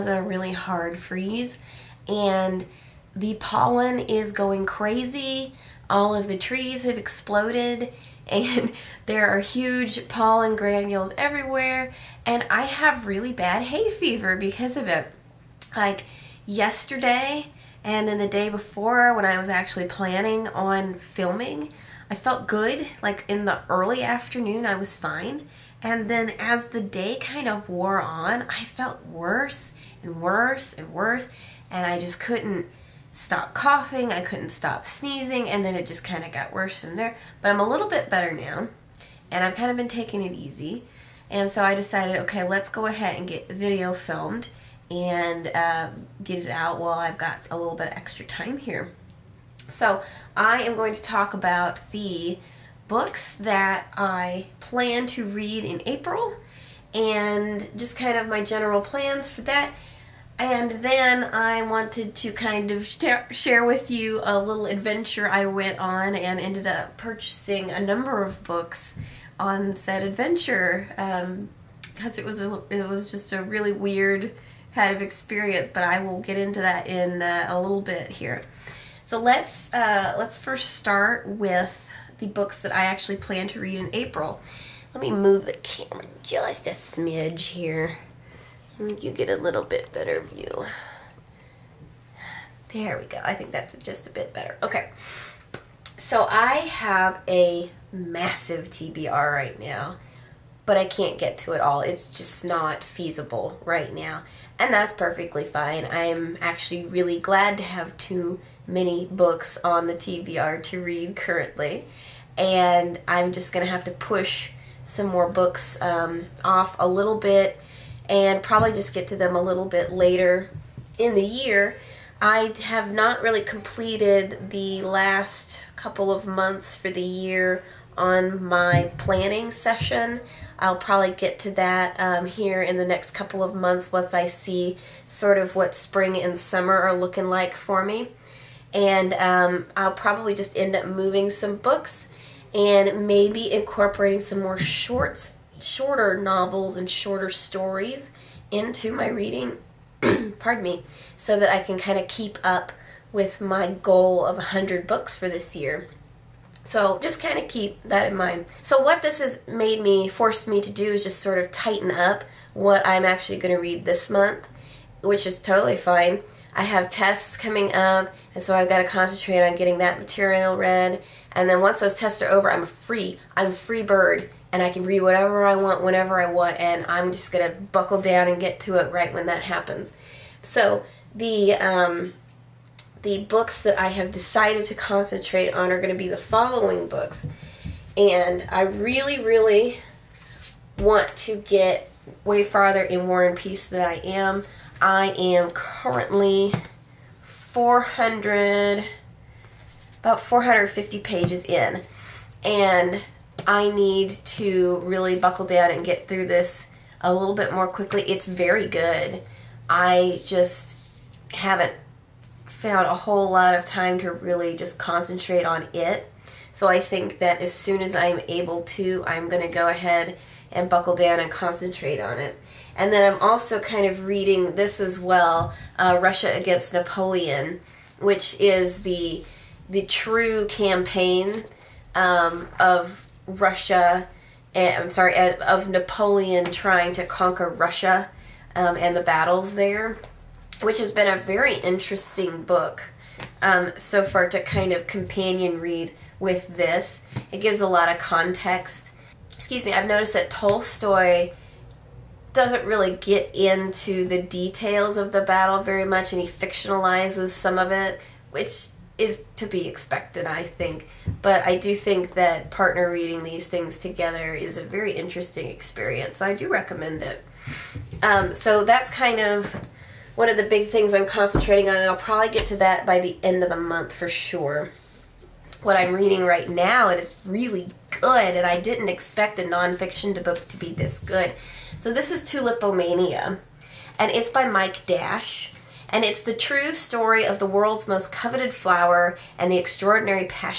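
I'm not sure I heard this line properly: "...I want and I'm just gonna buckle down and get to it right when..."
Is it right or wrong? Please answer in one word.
right.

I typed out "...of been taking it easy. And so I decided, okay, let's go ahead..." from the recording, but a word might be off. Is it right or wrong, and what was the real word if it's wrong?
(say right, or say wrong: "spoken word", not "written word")
right.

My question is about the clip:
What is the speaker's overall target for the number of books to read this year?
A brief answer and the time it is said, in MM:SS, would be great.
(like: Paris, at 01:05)
100 books, at 02:34.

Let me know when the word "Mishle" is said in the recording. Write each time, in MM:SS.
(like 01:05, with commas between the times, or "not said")
not said.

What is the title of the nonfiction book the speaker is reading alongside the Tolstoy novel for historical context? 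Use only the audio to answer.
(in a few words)
Russia Against Napoleon.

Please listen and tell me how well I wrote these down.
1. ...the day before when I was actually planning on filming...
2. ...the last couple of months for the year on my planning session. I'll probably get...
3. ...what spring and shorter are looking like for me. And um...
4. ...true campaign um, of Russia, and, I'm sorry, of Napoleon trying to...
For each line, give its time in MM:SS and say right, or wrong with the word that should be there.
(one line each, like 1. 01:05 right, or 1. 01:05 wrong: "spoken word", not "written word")
1. 00:18 right
2. 02:04 right
3. 02:15 wrong: "summer", not "shorter"
4. 03:49 right.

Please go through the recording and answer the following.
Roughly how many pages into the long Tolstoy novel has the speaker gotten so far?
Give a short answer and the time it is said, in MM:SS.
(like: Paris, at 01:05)
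450, at 03:20.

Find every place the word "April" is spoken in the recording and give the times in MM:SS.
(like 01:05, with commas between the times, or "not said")
00:55, 01:23.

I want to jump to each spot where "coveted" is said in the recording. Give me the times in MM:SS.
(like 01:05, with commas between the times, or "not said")
04:48.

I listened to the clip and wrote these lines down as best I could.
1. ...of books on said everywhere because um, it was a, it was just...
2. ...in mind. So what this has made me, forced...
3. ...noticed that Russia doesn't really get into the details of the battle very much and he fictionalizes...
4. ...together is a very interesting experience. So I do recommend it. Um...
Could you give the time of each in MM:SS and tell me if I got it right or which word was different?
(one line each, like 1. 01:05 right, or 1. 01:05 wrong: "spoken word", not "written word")
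1. 01:08 wrong: "adventure", not "everywhere"
2. 02:38 right
3. 04:09 wrong: "Tolstoy", not "Russia"
4. 04:23 right.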